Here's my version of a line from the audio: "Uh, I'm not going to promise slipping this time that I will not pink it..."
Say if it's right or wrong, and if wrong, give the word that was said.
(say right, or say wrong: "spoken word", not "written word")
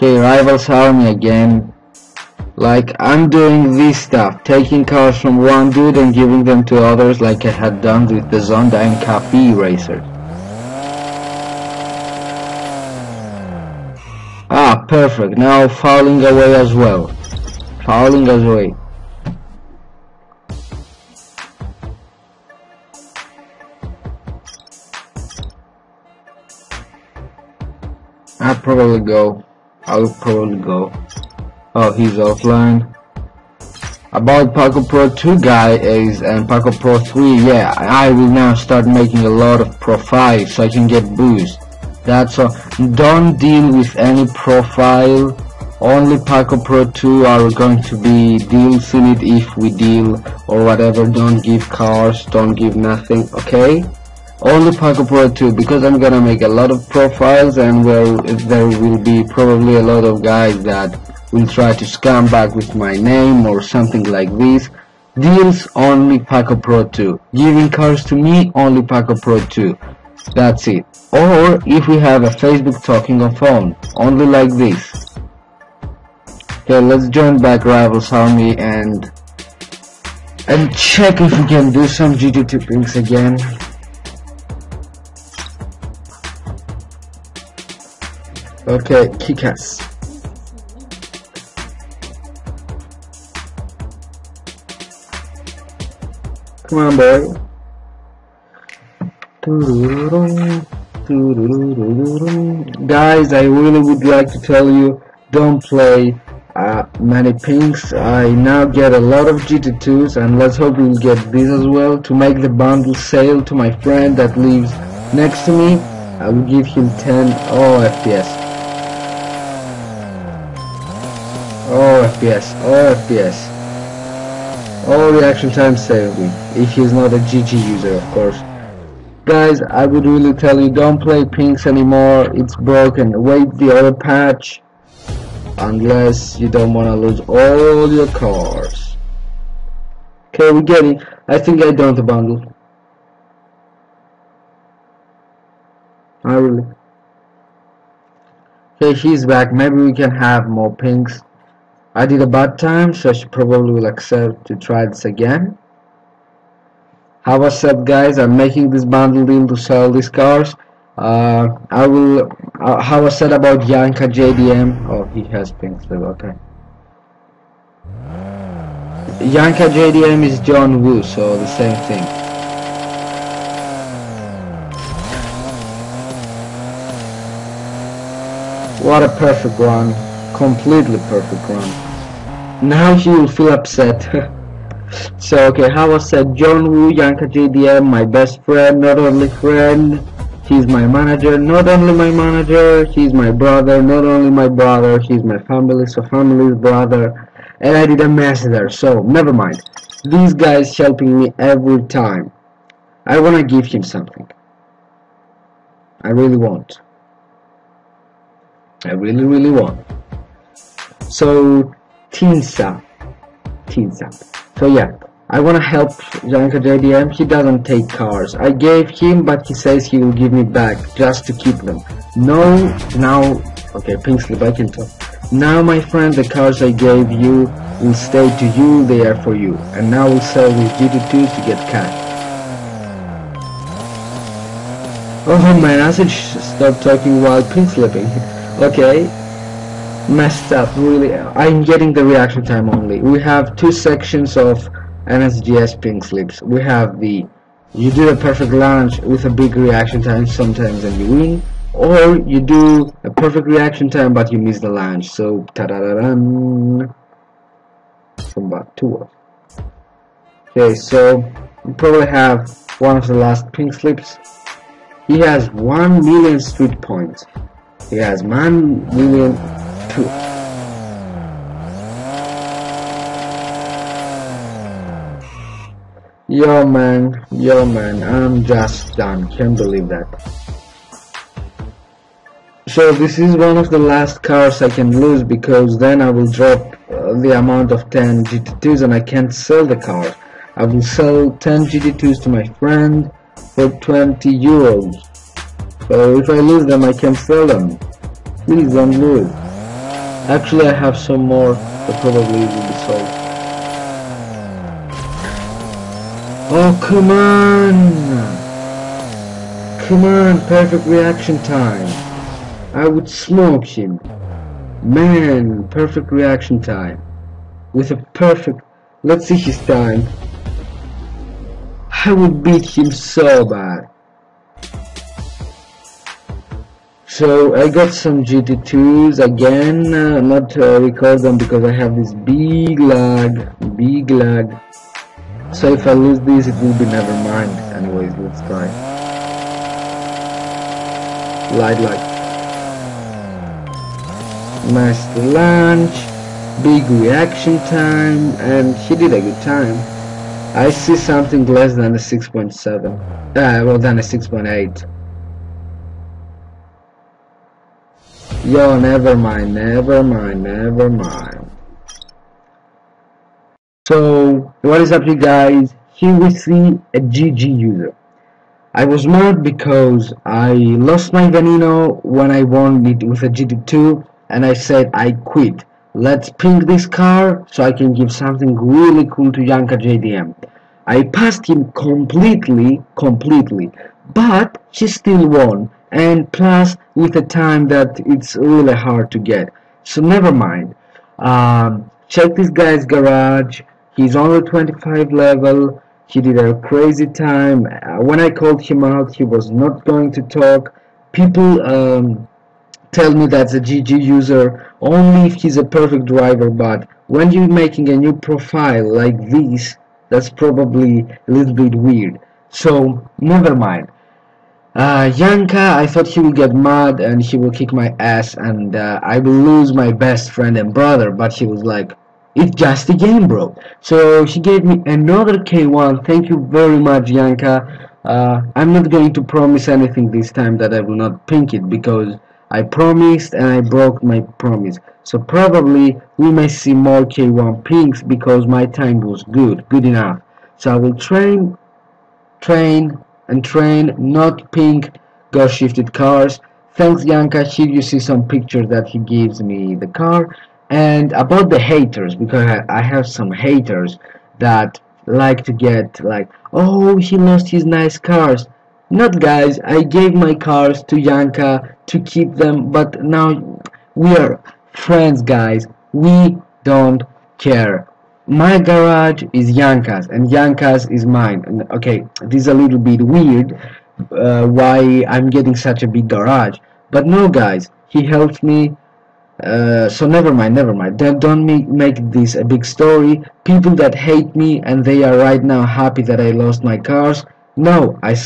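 wrong: "anything", not "slipping".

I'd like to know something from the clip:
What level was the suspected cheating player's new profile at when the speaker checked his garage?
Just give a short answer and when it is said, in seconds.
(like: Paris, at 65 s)
25, at 394 s.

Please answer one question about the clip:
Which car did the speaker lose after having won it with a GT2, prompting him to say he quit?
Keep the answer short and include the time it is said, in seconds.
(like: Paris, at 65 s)
Veneno, at 371 s.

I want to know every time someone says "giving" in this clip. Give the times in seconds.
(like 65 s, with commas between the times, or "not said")
6 s, 67 s.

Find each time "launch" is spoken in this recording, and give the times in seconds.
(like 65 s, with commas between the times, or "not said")
248 s, 254 s, 345 s.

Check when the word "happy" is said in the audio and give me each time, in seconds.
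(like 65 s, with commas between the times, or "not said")
485 s.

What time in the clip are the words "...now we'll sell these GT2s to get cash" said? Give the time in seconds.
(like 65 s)
229 s.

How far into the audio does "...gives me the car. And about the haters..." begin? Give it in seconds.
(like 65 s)
448 s.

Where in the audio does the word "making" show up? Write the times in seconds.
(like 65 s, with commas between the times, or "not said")
38 s, 158 s, 407 s.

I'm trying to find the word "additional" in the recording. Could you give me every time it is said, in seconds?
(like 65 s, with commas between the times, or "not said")
not said.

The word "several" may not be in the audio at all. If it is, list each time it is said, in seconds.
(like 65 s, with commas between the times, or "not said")
not said.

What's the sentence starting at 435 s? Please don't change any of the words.
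So probably we may see more K1 pinks because my time was good, good enough.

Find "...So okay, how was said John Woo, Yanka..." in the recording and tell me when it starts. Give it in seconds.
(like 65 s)
185 s.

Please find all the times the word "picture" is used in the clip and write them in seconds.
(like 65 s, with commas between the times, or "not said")
448 s.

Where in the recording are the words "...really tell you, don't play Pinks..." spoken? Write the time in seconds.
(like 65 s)
130 s.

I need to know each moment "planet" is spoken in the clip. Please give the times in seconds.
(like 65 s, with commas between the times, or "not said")
not said.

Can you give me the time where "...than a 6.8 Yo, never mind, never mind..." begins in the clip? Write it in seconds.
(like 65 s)
353 s.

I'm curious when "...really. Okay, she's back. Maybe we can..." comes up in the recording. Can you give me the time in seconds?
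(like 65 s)
146 s.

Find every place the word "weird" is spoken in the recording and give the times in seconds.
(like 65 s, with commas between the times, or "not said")
411 s, 473 s.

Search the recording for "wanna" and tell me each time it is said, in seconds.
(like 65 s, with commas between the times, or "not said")
203 s, 215 s.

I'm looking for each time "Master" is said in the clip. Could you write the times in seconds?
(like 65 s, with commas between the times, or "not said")
344 s.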